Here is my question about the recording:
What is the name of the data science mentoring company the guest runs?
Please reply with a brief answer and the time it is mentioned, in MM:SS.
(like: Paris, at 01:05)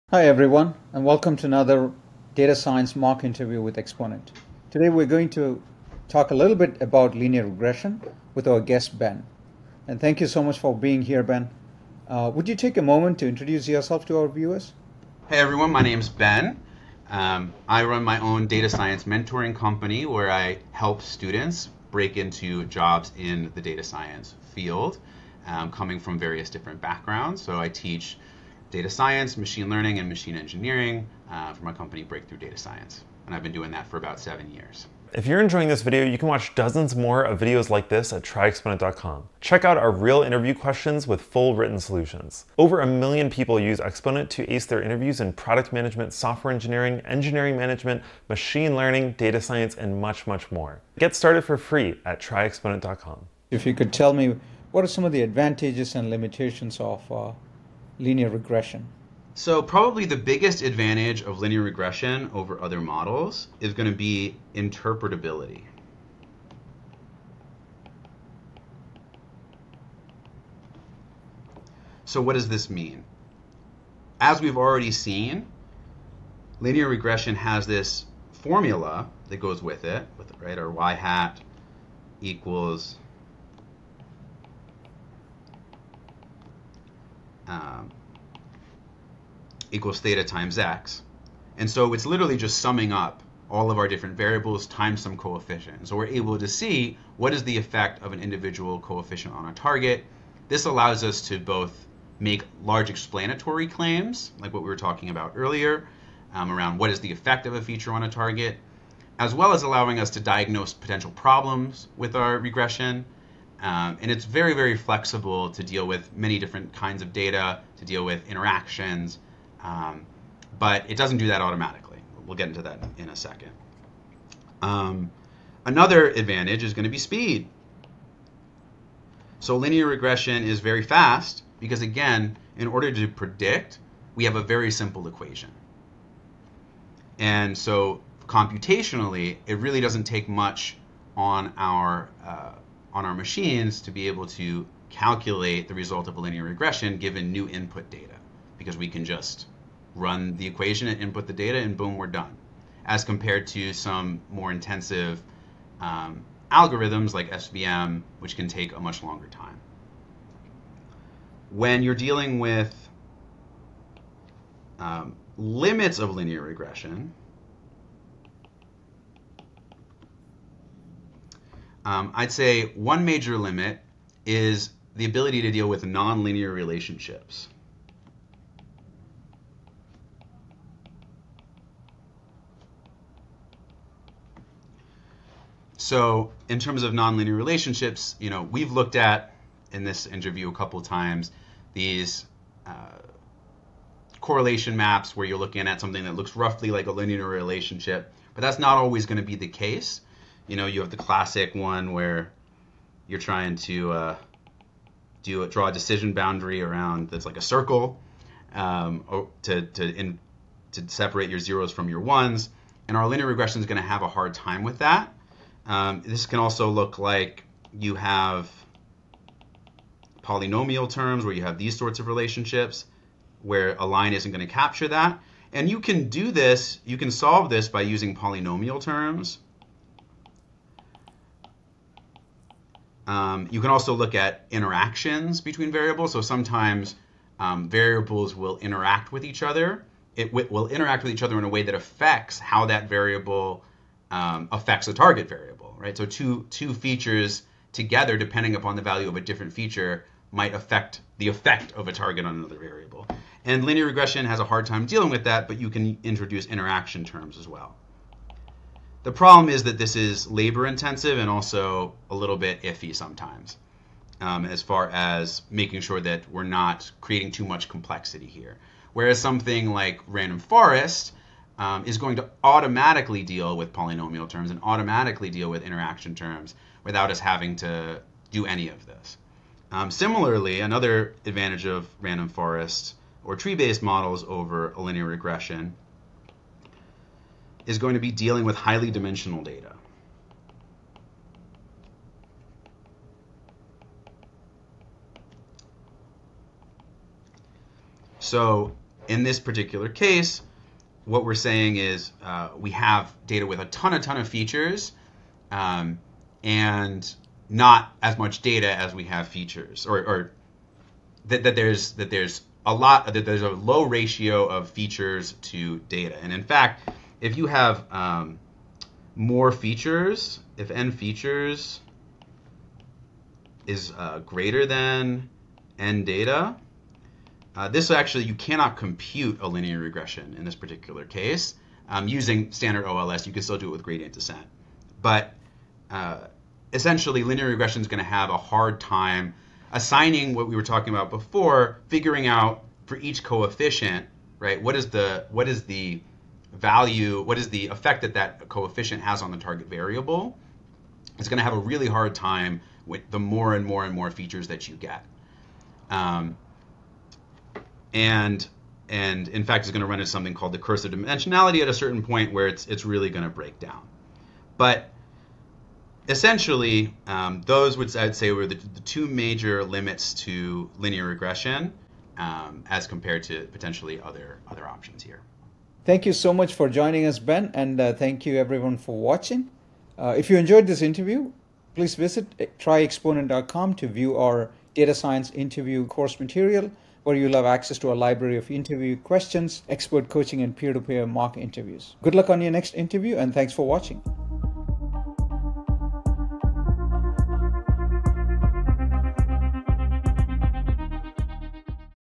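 Breakthrough Data Science, at 00:32.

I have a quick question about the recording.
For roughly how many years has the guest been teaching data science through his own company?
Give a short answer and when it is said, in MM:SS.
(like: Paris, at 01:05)
7 years, at 00:34.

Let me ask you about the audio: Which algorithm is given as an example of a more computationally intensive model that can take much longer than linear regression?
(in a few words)
SVM.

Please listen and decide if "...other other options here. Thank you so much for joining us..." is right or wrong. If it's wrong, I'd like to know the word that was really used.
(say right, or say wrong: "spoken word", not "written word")
right.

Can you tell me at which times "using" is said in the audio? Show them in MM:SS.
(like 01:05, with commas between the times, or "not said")
03:47, 05:32.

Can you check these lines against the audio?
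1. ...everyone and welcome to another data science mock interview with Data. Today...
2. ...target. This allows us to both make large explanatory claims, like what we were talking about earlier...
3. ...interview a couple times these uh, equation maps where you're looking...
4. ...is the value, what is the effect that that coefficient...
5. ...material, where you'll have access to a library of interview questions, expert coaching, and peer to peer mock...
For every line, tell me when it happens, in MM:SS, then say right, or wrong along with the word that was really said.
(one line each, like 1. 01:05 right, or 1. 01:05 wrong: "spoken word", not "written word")
1. 00:00 wrong: "Exponent", not "Data"
2. 01:39 right
3. 03:10 wrong: "correlation", not "equation"
4. 05:45 right
5. 06:26 right.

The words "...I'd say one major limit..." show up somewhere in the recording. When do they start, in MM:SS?
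02:52.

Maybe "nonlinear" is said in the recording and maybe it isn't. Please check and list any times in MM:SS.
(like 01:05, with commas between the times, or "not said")
02:55, 03:06.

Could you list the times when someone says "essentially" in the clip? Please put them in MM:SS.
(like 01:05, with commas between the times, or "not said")
05:36, 06:06.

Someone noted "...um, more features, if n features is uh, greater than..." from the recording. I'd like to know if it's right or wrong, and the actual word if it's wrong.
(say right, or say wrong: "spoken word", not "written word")
right.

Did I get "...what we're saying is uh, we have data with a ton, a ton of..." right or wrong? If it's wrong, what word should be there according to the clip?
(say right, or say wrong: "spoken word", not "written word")
right.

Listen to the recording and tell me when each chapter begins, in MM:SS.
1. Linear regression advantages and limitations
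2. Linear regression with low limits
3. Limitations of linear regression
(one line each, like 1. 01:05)
1. 00:12
2. 02:12
3. 06:04.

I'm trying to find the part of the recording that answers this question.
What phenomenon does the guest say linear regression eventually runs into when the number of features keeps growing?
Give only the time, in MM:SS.
06:00.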